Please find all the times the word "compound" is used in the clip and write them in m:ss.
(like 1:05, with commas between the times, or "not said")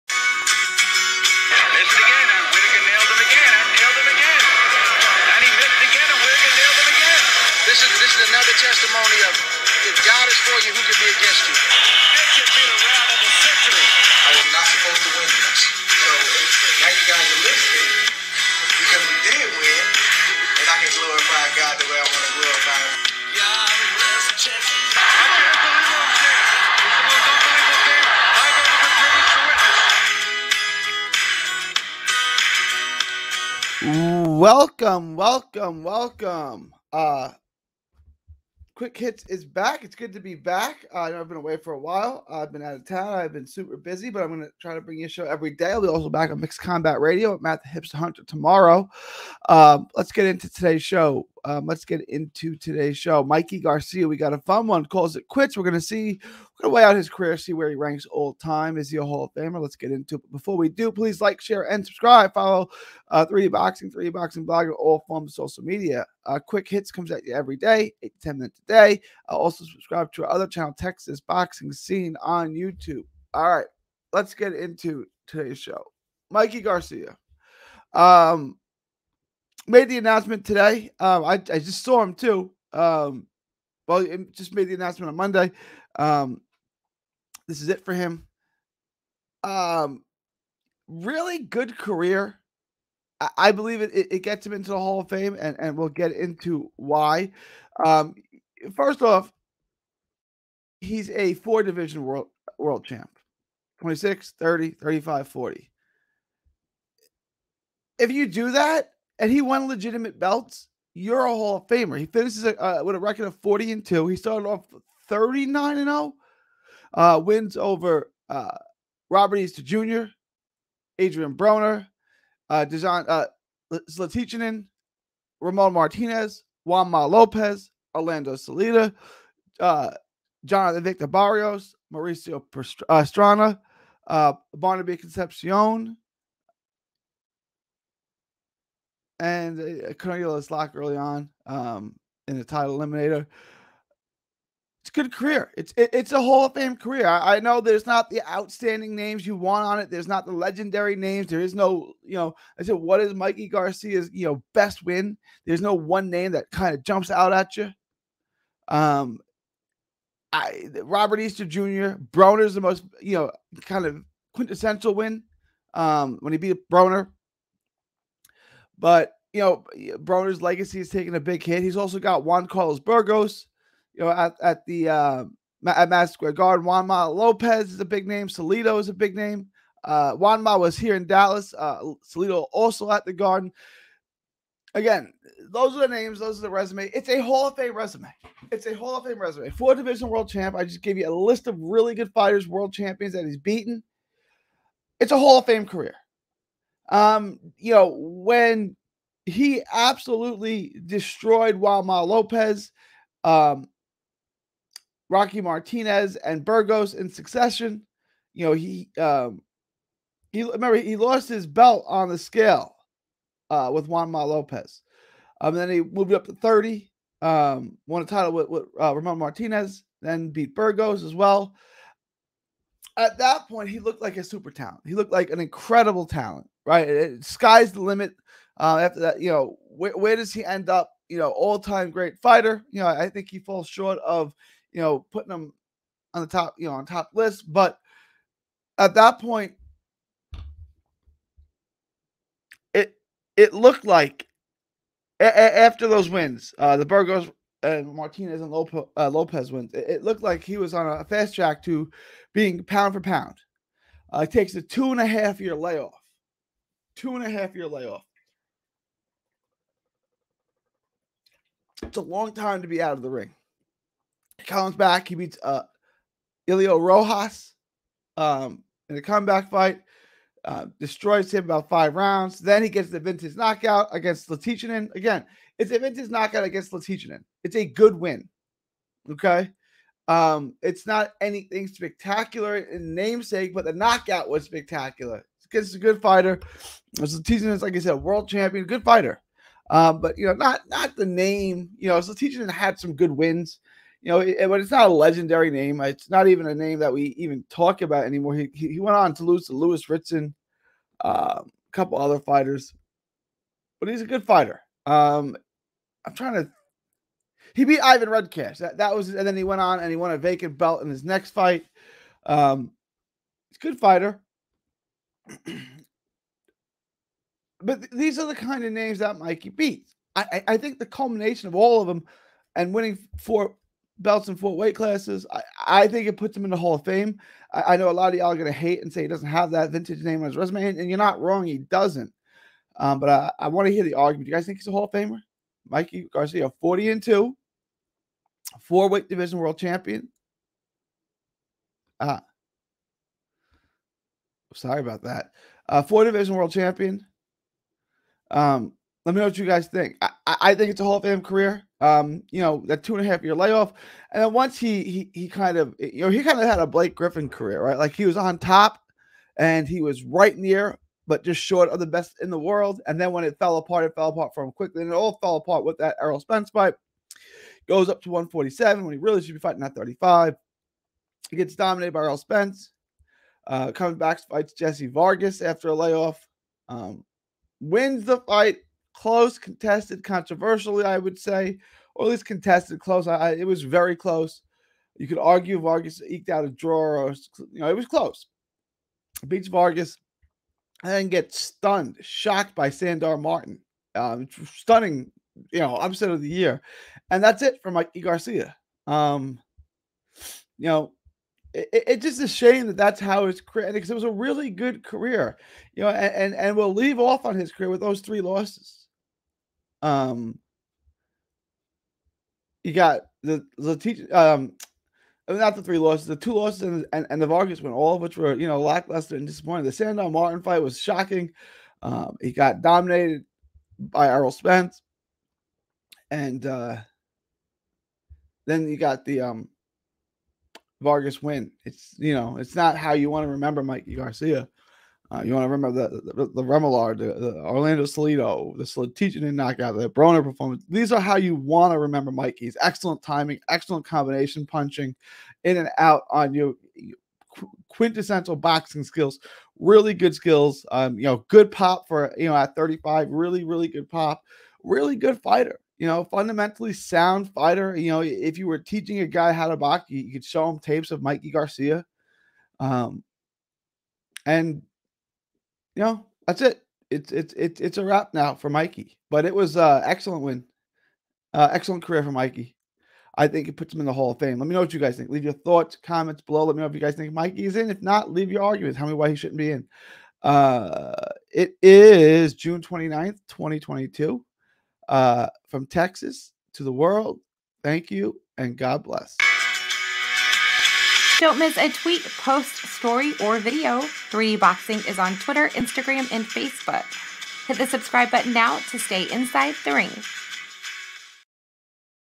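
not said.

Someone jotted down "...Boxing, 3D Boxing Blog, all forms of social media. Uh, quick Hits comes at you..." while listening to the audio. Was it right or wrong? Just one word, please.
right.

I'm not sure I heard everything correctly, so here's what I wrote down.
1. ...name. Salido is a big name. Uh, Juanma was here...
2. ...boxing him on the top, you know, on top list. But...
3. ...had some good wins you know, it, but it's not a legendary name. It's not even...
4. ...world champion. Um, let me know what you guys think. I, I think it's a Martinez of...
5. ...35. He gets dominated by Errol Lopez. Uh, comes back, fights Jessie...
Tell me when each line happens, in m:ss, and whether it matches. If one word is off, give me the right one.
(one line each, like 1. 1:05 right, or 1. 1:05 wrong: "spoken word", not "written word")
1. 2:58 right
2. 3:55 wrong: "putting", not "boxing"
3. 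4:52 right
4. 5:46 wrong: "Hall", not "Martinez"
5. 6:09 wrong: "Spence", not "Lopez".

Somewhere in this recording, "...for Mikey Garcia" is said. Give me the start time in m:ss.
6:37.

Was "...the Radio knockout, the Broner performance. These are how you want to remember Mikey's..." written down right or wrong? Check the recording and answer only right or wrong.
wrong.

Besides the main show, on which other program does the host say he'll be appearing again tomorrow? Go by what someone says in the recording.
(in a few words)
Mixed Combat Radio.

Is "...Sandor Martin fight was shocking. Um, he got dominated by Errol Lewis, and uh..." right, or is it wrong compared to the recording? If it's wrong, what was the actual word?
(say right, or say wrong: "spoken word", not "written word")
wrong: "Spence", not "Lewis".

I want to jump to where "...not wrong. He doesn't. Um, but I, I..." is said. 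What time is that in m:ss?
5:30.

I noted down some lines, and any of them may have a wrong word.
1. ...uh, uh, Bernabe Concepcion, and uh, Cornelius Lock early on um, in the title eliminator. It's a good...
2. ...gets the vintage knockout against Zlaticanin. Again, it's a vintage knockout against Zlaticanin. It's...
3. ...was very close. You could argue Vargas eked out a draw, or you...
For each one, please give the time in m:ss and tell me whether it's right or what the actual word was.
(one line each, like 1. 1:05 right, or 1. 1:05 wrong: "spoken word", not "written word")
1. 2:14 right
2. 4:32 right
3. 6:23 right.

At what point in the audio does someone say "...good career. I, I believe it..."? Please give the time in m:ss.
1:31.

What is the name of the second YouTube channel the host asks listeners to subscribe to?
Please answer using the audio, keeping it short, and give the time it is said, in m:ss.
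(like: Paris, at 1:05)
Texas Boxing Scene, at 1:10.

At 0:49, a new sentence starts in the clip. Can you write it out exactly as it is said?
Uh, let's get into today's show.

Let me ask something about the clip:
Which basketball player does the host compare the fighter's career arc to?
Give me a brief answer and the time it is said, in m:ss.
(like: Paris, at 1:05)
Blake Griffin, at 5:56.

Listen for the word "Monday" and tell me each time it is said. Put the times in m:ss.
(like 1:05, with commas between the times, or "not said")
1:25.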